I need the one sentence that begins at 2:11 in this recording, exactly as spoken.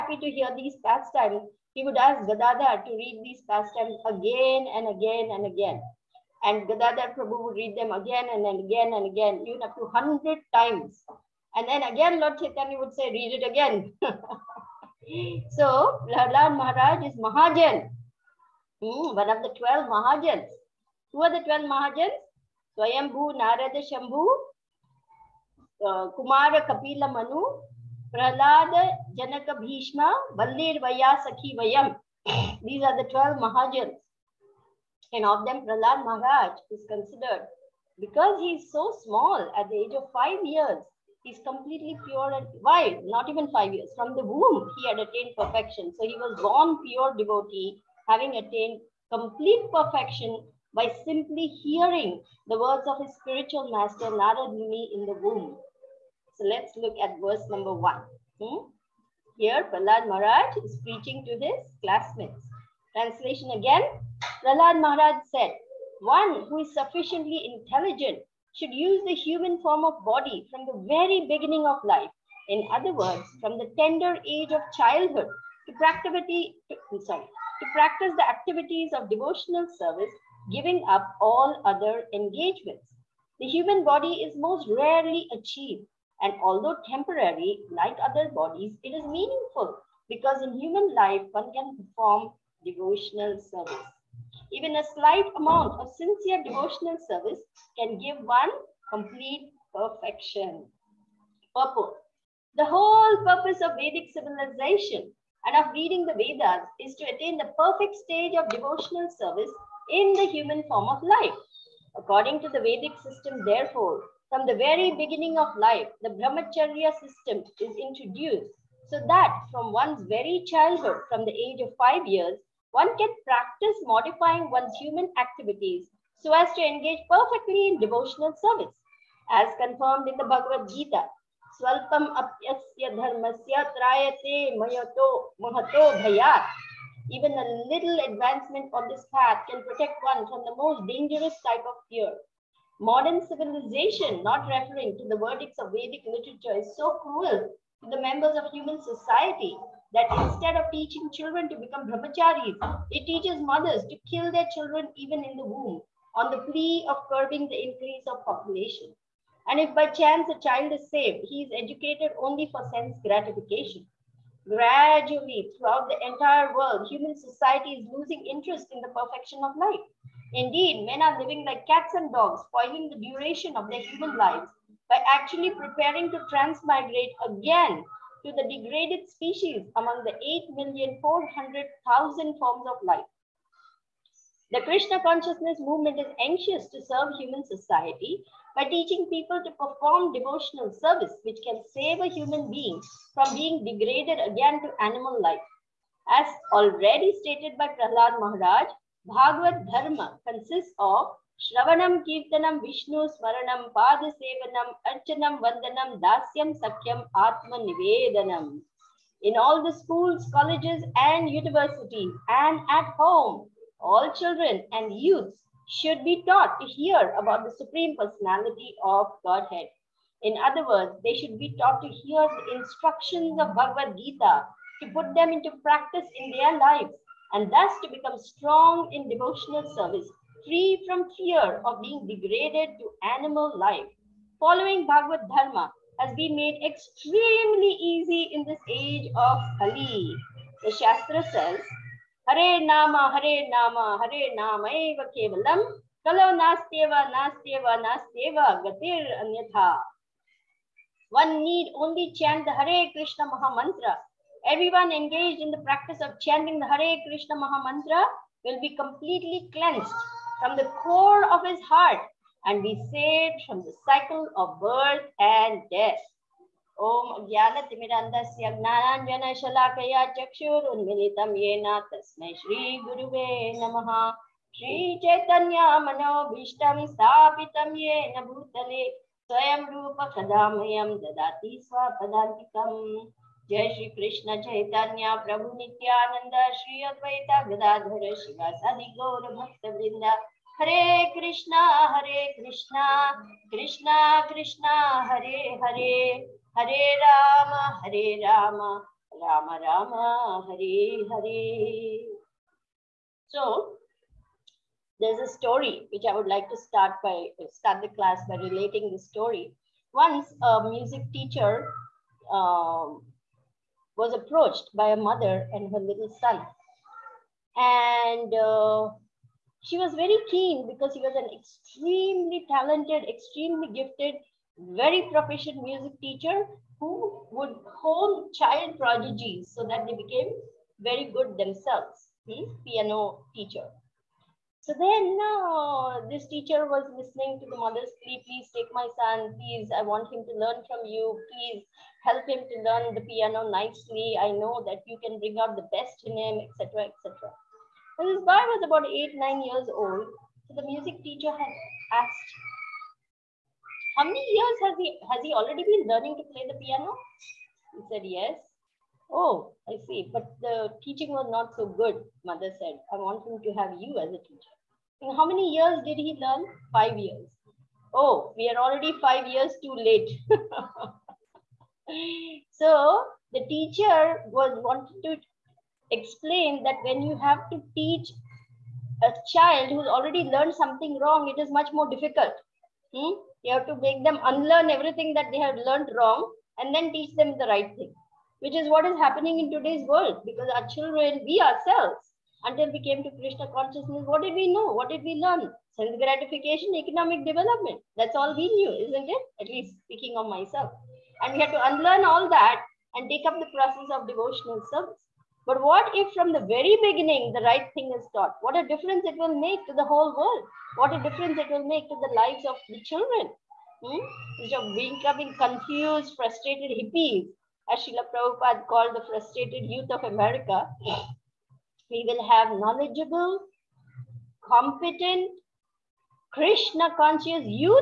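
Swalpam apyasya dharmasya trayate mayato mahato bhayat.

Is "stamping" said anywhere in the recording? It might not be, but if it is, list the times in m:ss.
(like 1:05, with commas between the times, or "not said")
not said.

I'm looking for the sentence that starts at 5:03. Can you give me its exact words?
So, there's a story which I would like to start by start the class by relating the story.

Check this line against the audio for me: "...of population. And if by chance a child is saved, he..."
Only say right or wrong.
right.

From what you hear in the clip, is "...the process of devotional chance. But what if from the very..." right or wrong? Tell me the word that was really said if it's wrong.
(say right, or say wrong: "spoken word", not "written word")
wrong: "service", not "chance".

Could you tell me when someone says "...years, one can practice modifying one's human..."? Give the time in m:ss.
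2:02.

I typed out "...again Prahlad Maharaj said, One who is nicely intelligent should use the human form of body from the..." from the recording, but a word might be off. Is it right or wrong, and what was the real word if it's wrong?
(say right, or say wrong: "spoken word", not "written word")
wrong: "sufficiently", not "nicely".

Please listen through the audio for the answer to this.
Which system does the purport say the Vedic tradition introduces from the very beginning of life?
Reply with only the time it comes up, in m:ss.
1:56.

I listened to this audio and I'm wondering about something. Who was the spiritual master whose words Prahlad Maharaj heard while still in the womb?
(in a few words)
Narad Muni.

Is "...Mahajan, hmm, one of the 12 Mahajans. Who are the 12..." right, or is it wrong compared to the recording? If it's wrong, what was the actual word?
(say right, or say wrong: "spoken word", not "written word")
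right.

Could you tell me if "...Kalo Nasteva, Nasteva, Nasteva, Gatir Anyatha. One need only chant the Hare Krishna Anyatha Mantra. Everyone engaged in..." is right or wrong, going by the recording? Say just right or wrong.
wrong.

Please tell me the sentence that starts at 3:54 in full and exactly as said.
Following Bhagavad Dharma has been made extremely easy in this age of Kali.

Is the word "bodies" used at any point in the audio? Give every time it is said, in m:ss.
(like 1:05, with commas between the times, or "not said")
1:28.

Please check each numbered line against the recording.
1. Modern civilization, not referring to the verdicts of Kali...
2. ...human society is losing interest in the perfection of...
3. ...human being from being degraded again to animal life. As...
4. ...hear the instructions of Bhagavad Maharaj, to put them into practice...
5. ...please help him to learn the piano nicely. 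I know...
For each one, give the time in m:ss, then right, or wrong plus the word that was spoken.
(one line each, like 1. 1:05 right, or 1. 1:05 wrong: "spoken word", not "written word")
1. 2:22 wrong: "Vedic", not "Kali"
2. 2:46 right
3. 3:12 right
4. 3:41 wrong: "Gita", not "Maharaj"
5. 5:41 right.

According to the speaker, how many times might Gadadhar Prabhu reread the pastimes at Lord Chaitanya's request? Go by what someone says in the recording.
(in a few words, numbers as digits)
100.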